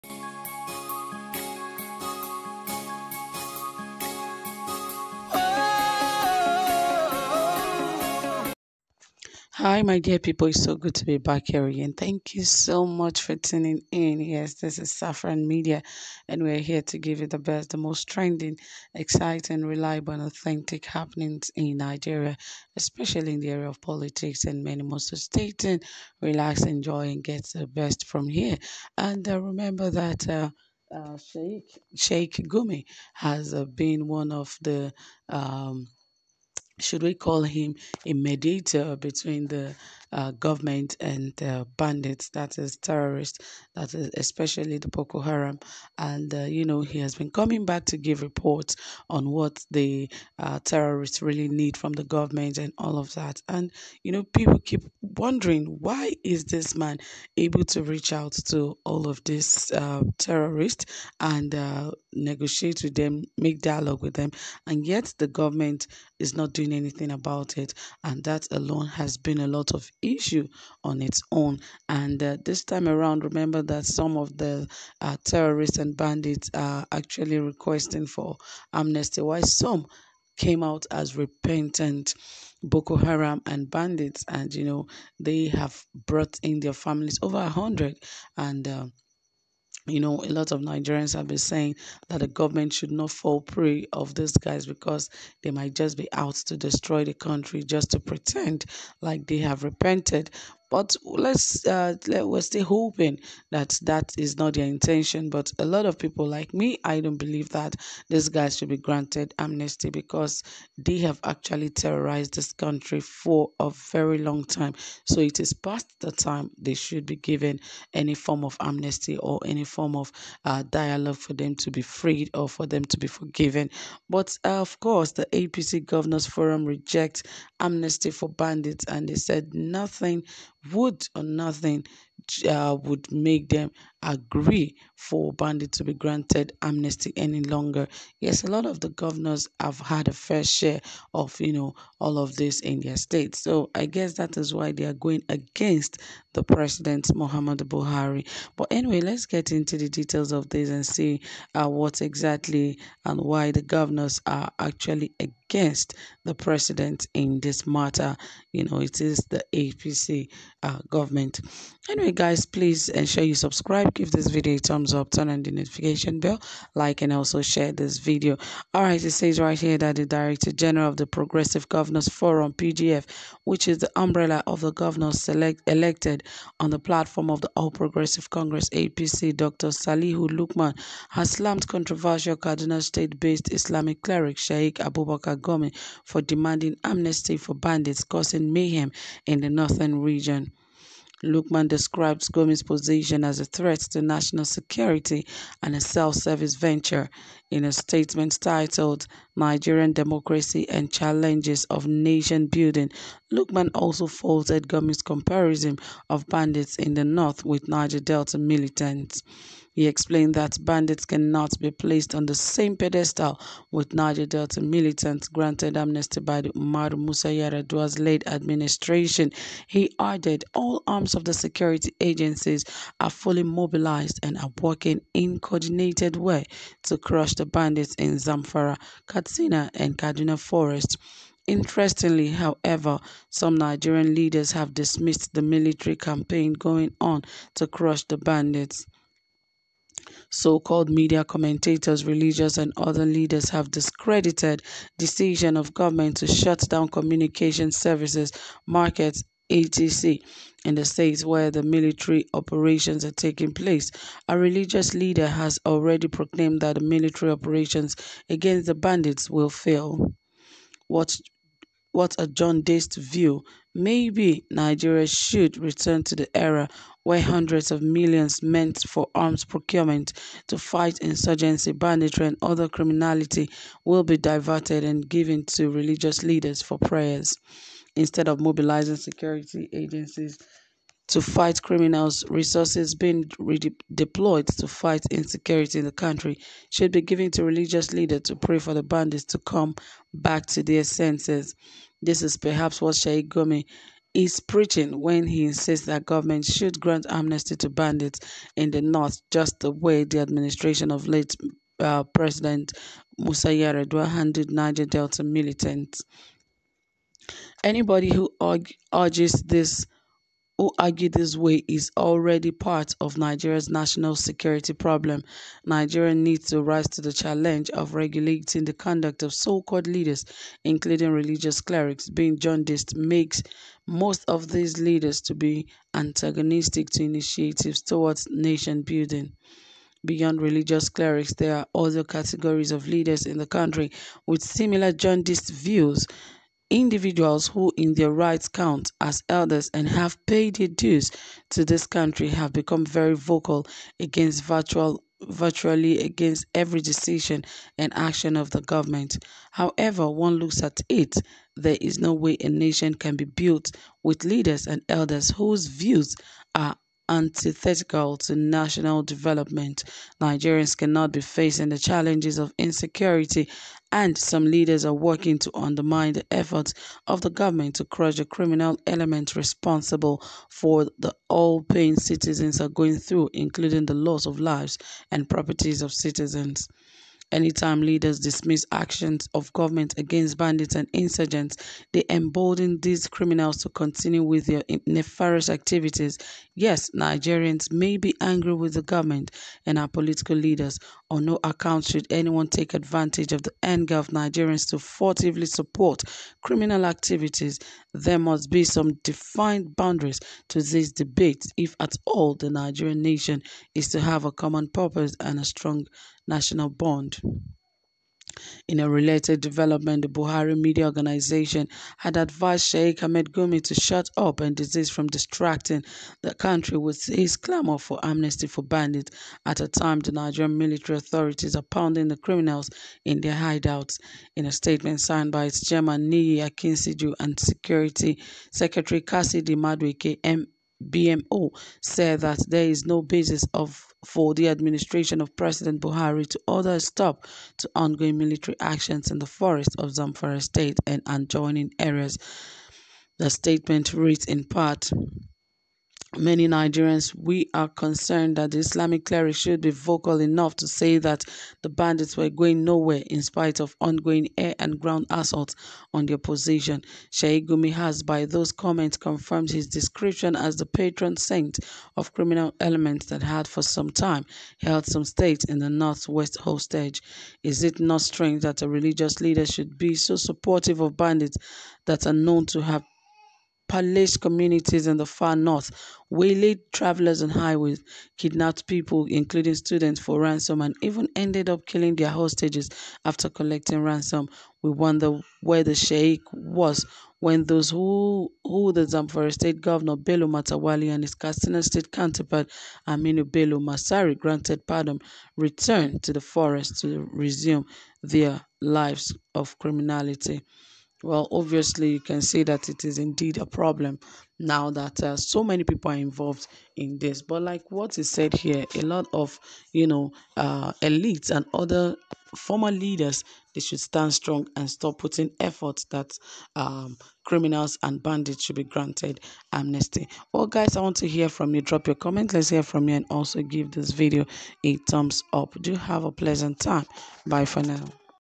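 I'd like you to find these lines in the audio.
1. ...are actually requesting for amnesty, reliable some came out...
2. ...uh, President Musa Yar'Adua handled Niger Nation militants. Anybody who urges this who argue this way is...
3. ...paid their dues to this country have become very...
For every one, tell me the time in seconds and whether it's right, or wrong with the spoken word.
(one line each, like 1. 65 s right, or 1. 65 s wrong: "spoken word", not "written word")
1. 76 s wrong: "while", not "reliable"
2. 301 s wrong: "Delta", not "Nation"
3. 340 s right.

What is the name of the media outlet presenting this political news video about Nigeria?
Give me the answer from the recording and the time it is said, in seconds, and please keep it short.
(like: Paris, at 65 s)
Saffron Media, at 14 s.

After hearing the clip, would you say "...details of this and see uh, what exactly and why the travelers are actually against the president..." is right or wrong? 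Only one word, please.
wrong.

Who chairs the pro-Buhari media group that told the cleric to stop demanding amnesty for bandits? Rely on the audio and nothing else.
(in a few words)
Niyi Akinsiju.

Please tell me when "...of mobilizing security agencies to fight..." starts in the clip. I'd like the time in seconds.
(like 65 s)
278 s.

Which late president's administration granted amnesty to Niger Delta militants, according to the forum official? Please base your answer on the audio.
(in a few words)
Umar Musa Yar'Adua.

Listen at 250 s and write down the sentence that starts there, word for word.
in the states where the military operations are taking place.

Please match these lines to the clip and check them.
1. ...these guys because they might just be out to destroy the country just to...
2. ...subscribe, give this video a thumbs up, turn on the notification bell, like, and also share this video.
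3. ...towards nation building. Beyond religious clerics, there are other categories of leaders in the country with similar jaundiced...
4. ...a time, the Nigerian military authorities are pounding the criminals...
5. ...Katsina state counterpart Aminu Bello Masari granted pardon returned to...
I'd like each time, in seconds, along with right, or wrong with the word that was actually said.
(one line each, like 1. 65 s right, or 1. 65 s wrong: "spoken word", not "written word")
1. 94 s right
2. 163 s right
3. 327 s right
4. 419 s right
5. 491 s right.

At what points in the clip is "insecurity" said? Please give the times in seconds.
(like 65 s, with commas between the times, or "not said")
285 s, 362 s.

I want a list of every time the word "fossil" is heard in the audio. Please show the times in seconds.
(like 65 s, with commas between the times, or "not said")
not said.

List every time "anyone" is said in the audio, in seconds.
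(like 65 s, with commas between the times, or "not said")
392 s.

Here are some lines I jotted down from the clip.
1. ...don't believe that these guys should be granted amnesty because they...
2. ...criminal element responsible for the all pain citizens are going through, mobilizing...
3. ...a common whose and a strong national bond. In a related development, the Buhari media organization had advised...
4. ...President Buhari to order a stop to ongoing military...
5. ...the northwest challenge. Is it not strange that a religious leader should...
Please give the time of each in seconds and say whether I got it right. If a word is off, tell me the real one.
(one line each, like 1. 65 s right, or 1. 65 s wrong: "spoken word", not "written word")
1. 107 s right
2. 368 s wrong: "including", not "mobilizing"
3. 404 s wrong: "purpose", not "whose"
4. 435 s right
5. 465 s wrong: "hostage", not "challenge".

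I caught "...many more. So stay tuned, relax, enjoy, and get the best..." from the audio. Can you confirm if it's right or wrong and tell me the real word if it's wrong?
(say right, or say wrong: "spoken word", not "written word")
right.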